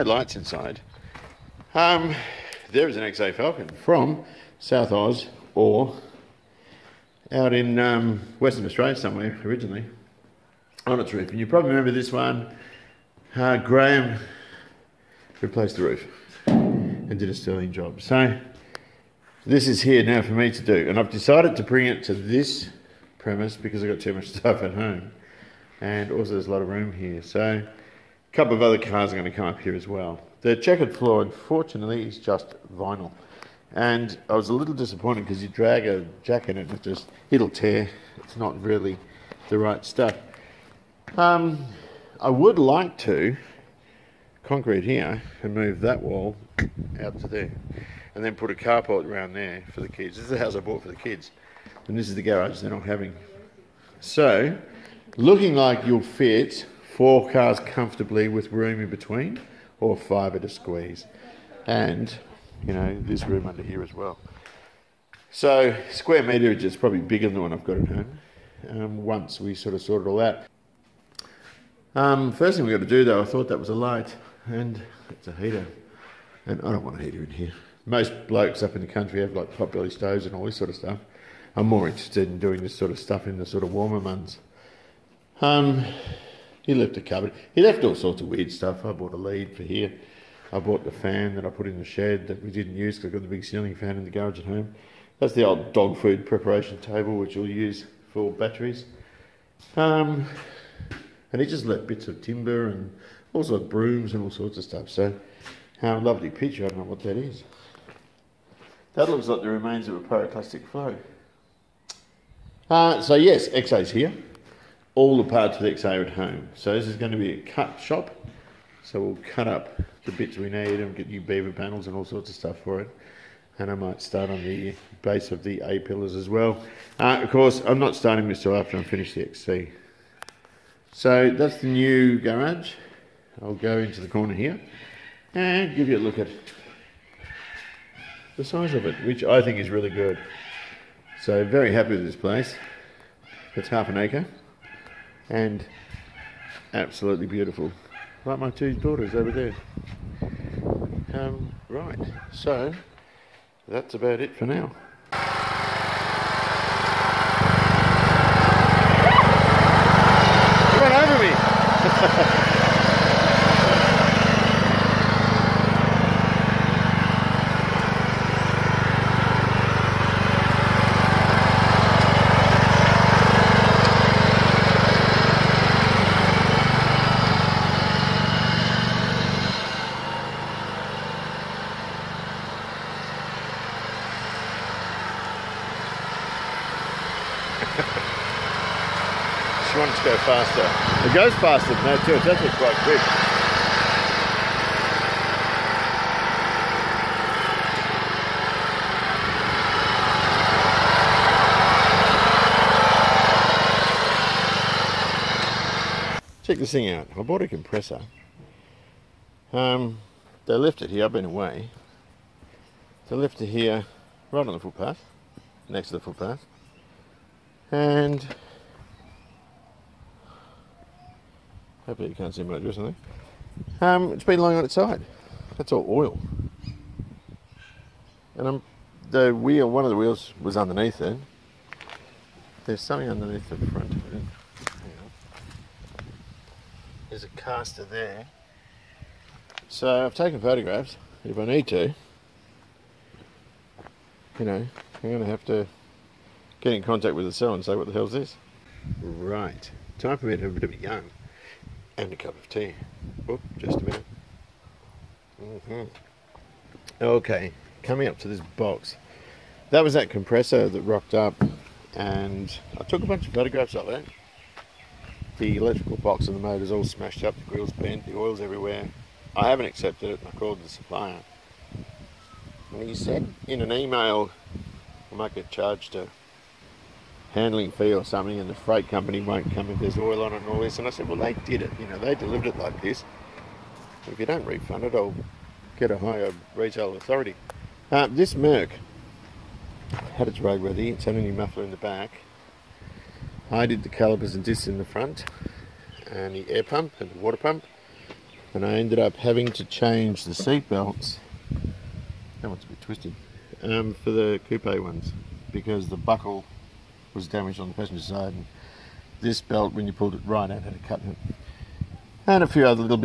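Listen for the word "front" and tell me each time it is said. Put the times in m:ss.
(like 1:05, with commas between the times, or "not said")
3:53, 4:54.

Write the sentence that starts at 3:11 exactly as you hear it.
It goes faster than that too, it's actually quite quick.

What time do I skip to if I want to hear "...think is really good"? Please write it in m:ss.
2:19.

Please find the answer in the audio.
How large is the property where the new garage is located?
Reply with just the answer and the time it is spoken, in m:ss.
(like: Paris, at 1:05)
Half an acre, at 2:23.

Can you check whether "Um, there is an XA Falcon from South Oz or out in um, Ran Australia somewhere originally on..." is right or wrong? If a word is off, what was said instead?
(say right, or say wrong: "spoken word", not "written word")
wrong: "Western", not "Ran".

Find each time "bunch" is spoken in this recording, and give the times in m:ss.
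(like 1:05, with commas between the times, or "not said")
4:23.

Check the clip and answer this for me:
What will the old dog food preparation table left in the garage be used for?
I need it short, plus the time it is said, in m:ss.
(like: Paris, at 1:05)
Batteries, at 1:38.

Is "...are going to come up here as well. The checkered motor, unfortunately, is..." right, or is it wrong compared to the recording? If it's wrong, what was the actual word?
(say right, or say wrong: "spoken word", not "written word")
wrong: "floor", not "motor".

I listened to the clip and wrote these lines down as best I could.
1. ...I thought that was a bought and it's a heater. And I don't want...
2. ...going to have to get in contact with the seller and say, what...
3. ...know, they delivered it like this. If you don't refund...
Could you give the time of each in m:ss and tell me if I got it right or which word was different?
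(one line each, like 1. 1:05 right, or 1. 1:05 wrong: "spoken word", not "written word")
1. 1:13 wrong: "light", not "bought"
2. 4:05 right
3. 4:41 right.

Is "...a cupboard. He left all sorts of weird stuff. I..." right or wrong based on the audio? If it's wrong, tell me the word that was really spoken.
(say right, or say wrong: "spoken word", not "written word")
right.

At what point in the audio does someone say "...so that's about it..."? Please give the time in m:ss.
2:32.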